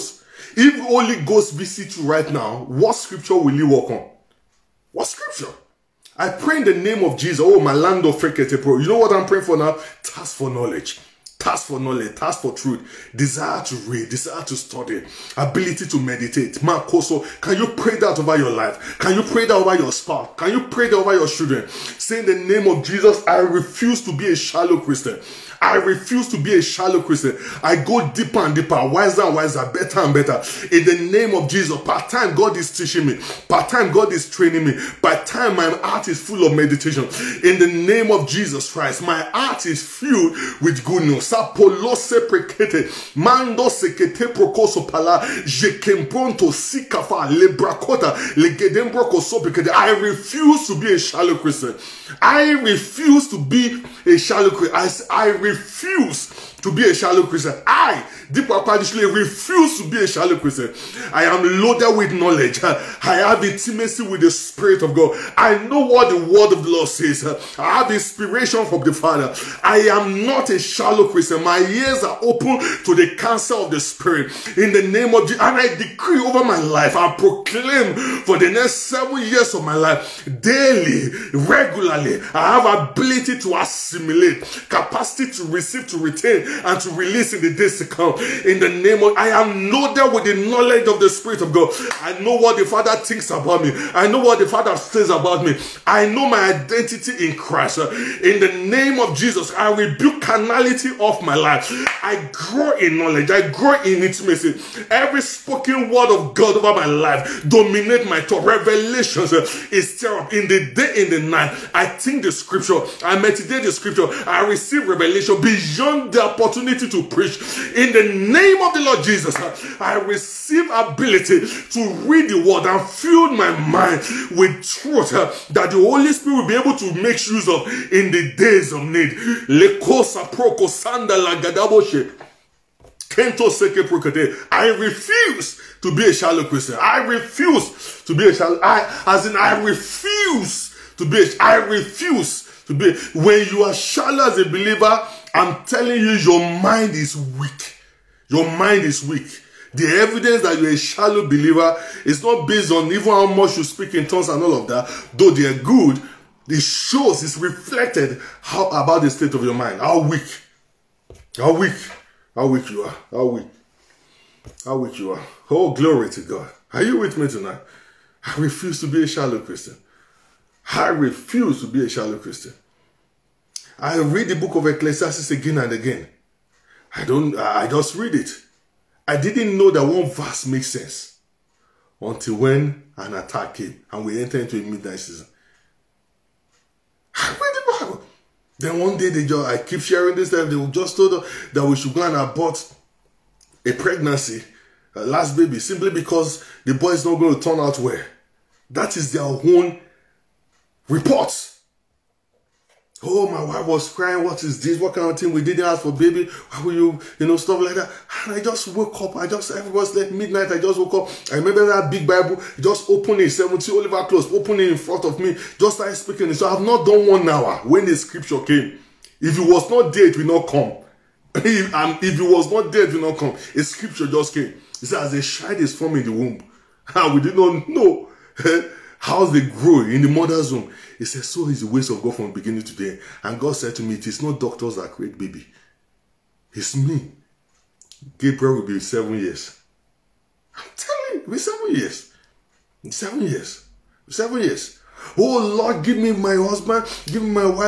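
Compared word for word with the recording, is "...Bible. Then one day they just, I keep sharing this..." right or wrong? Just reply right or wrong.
right.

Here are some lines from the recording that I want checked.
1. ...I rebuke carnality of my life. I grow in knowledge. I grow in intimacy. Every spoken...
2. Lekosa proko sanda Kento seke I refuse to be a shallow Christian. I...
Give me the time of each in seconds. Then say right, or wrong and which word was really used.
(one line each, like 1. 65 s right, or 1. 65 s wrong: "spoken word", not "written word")
1. 99 s right
2. 129 s right.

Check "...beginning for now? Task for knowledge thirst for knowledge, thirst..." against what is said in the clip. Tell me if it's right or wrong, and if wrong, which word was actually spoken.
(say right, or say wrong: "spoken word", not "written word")
wrong: "praying", not "beginning".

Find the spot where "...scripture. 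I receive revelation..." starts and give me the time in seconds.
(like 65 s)
113 s.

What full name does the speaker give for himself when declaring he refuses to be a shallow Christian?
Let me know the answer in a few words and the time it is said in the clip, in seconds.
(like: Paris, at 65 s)
Dipo Apanisile, at 58 s.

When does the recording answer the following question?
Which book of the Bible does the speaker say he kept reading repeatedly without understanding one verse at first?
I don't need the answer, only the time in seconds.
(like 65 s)
174 s.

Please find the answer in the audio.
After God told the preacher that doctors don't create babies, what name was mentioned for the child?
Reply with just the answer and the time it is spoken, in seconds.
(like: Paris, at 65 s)
Gabriel, at 238 s.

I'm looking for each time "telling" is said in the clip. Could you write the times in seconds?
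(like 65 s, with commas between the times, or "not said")
145 s, 240 s.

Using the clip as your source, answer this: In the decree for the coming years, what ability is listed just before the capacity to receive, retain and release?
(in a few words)
Assimilate.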